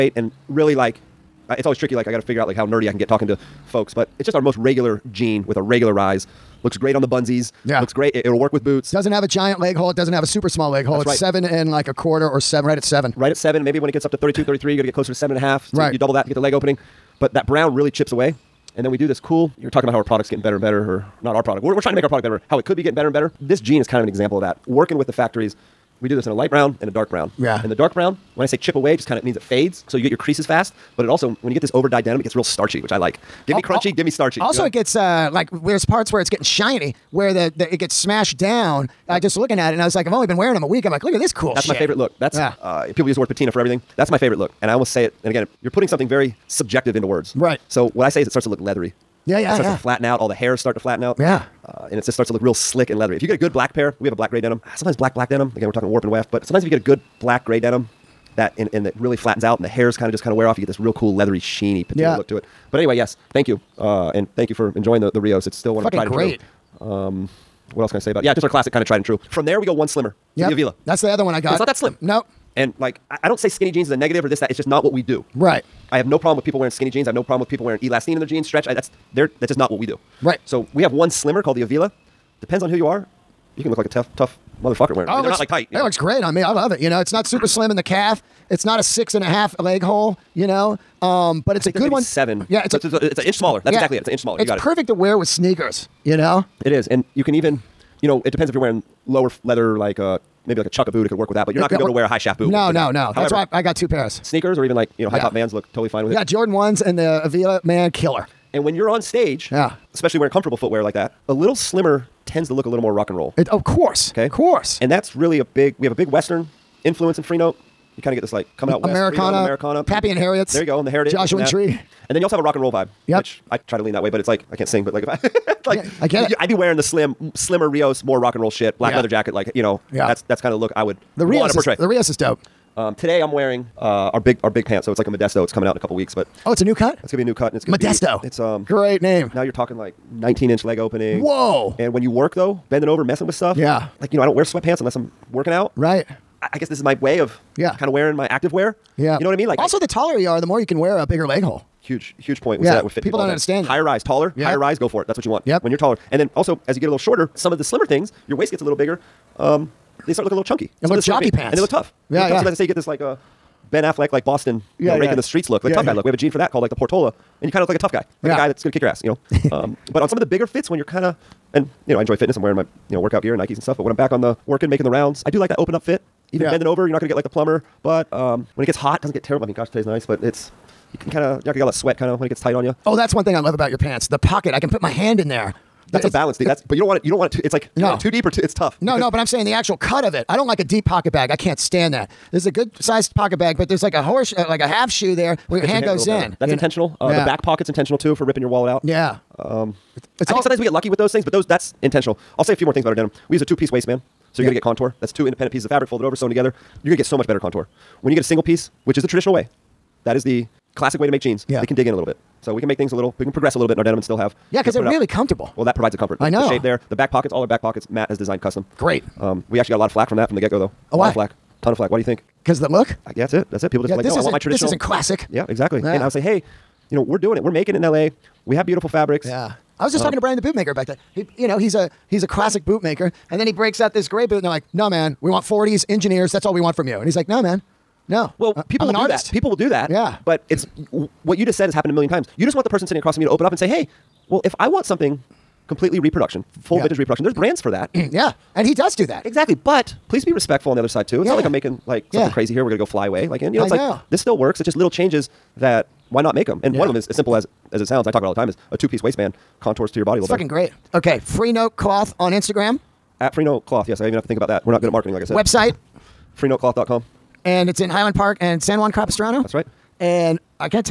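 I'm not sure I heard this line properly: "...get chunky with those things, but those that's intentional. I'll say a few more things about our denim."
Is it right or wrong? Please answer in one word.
wrong.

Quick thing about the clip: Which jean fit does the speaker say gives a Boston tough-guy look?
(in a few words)
Portola.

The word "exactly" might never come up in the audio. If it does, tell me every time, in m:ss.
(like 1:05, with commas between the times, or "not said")
1:33, 3:45, 4:09.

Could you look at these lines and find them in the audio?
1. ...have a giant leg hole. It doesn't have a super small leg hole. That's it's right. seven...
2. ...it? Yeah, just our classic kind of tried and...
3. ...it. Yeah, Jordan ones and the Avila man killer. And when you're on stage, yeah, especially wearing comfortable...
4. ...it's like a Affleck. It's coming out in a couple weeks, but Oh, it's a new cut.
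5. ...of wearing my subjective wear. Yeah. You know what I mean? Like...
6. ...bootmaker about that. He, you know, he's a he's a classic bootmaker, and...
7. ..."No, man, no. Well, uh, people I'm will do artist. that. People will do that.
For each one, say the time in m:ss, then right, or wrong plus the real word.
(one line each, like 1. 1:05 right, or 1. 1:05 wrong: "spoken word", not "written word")
1. 0:09 right
2. 1:08 right
3. 1:46 right
4. 2:14 wrong: "Modesto", not "Affleck"
5. 2:27 wrong: "active", not "subjective"
6. 3:50 right
7. 3:57 right.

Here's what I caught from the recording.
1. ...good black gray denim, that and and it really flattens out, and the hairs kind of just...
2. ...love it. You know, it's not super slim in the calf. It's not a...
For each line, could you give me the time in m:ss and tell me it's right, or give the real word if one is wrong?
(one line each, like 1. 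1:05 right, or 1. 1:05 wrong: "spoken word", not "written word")
1. 0:56 right
2. 1:26 right.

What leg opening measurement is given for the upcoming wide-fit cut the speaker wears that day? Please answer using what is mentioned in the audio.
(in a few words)
19 inches.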